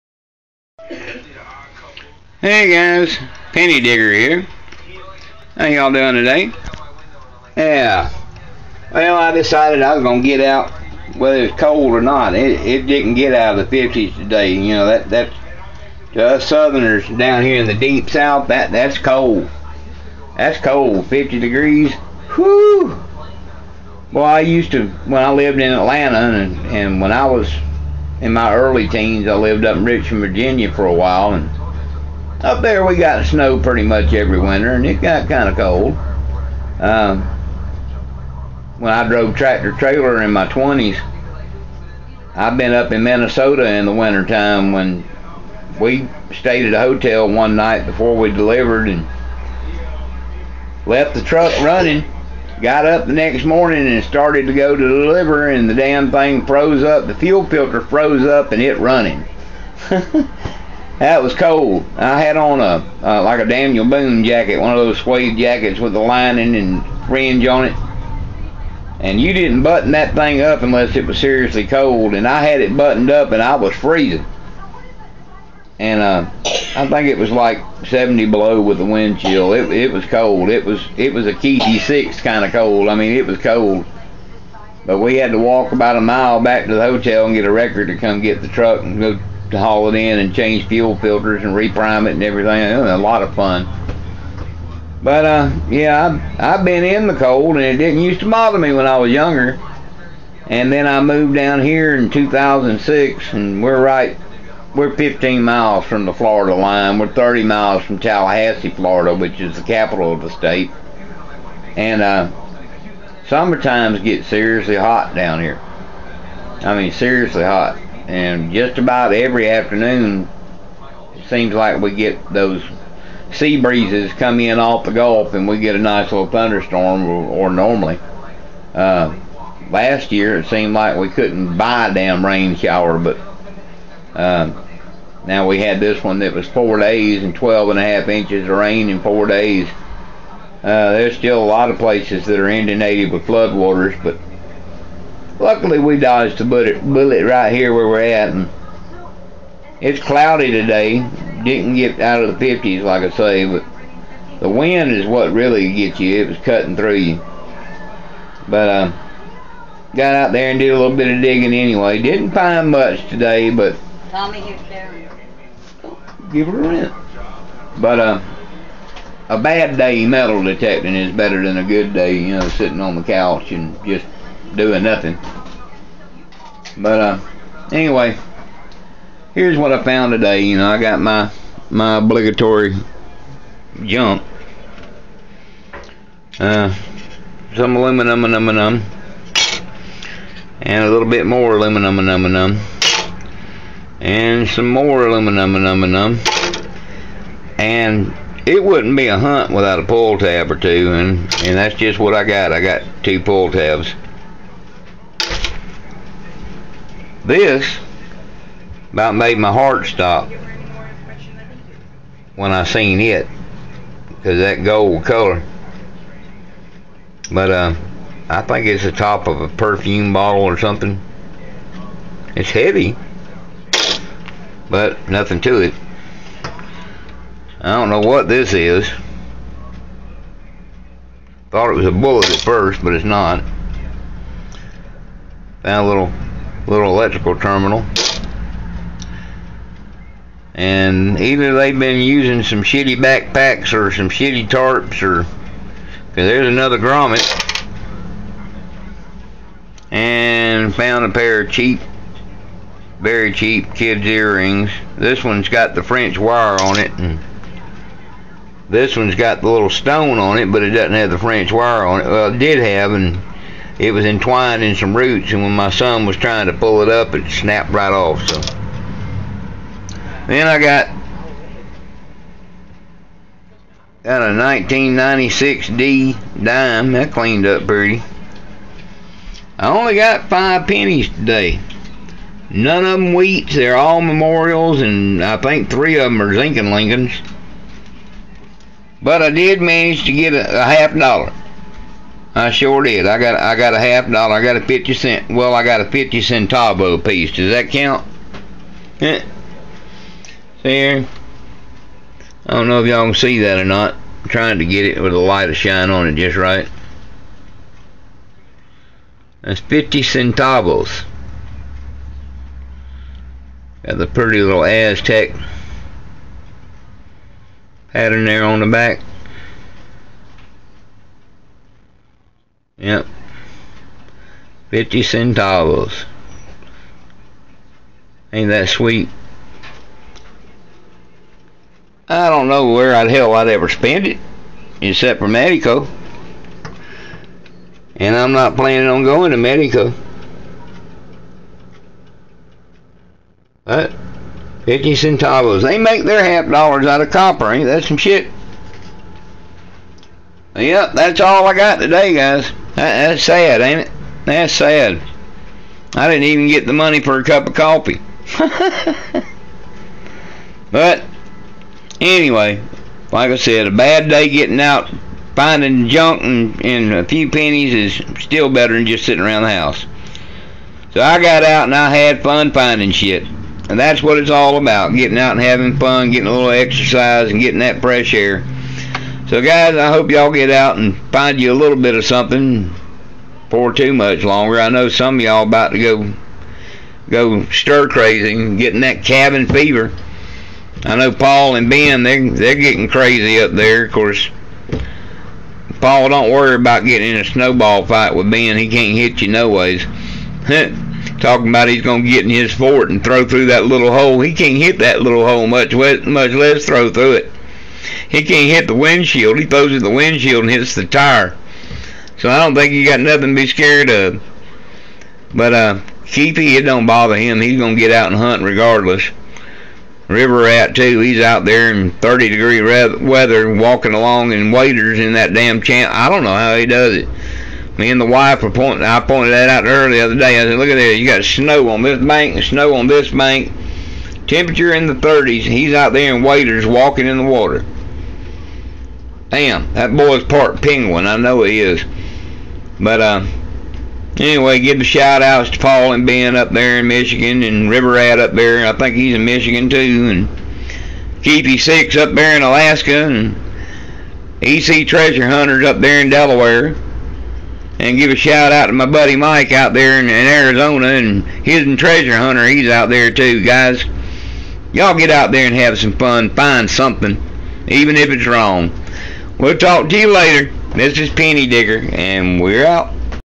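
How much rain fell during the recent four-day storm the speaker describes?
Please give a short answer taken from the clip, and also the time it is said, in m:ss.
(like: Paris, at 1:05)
12 and a half inches, at 2:17.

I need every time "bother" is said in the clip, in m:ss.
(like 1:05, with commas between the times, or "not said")
1:38, 6:56.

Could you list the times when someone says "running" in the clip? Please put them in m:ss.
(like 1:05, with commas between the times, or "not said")
0:51, 0:58.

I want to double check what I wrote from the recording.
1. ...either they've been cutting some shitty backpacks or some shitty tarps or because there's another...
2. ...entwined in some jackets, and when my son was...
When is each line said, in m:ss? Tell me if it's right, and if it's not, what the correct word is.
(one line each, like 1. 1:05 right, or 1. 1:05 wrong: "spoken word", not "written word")
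1. 4:01 wrong: "using", not "cutting"
2. 4:24 wrong: "roots", not "jackets".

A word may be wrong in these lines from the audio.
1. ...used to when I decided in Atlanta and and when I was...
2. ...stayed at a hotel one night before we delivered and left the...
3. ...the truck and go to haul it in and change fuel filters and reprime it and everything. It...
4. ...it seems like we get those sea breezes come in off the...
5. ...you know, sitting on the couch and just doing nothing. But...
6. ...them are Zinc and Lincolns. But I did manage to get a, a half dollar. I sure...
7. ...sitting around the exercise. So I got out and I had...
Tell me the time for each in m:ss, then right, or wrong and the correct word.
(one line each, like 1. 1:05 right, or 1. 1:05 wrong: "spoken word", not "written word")
1. 0:24 wrong: "lived", not "decided"
2. 0:46 right
3. 1:28 right
4. 2:01 right
5. 2:52 right
6. 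4:46 right
7. 6:09 wrong: "house", not "exercise".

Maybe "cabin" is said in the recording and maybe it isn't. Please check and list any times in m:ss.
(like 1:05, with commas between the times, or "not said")
6:29.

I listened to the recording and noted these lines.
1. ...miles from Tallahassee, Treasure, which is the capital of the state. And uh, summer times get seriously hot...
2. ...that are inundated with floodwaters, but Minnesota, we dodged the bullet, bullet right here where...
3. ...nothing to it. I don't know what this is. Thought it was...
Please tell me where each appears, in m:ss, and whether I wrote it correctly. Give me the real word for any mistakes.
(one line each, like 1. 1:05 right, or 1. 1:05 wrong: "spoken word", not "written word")
1. 1:47 wrong: "Florida", not "Treasure"
2. 2:22 wrong: "Luckily", not "Minnesota"
3. 3:45 right.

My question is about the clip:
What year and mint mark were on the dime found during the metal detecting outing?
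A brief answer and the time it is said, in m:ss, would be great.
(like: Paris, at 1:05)
1996 D, at 4:34.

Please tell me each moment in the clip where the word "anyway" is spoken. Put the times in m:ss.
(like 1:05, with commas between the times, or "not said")
2:41, 2:57, 6:01, 7:24.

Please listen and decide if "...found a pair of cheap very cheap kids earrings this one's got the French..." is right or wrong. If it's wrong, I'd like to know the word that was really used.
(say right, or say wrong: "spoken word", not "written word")
right.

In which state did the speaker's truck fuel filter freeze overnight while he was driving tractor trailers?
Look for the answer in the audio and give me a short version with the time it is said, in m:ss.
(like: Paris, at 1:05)
Minnesota, at 0:43.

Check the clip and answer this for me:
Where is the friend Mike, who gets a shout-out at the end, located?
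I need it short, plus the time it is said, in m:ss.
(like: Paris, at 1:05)
Arizona, at 7:40.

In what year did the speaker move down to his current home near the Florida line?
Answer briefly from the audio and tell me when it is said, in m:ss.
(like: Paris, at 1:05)
2006, at 1:42.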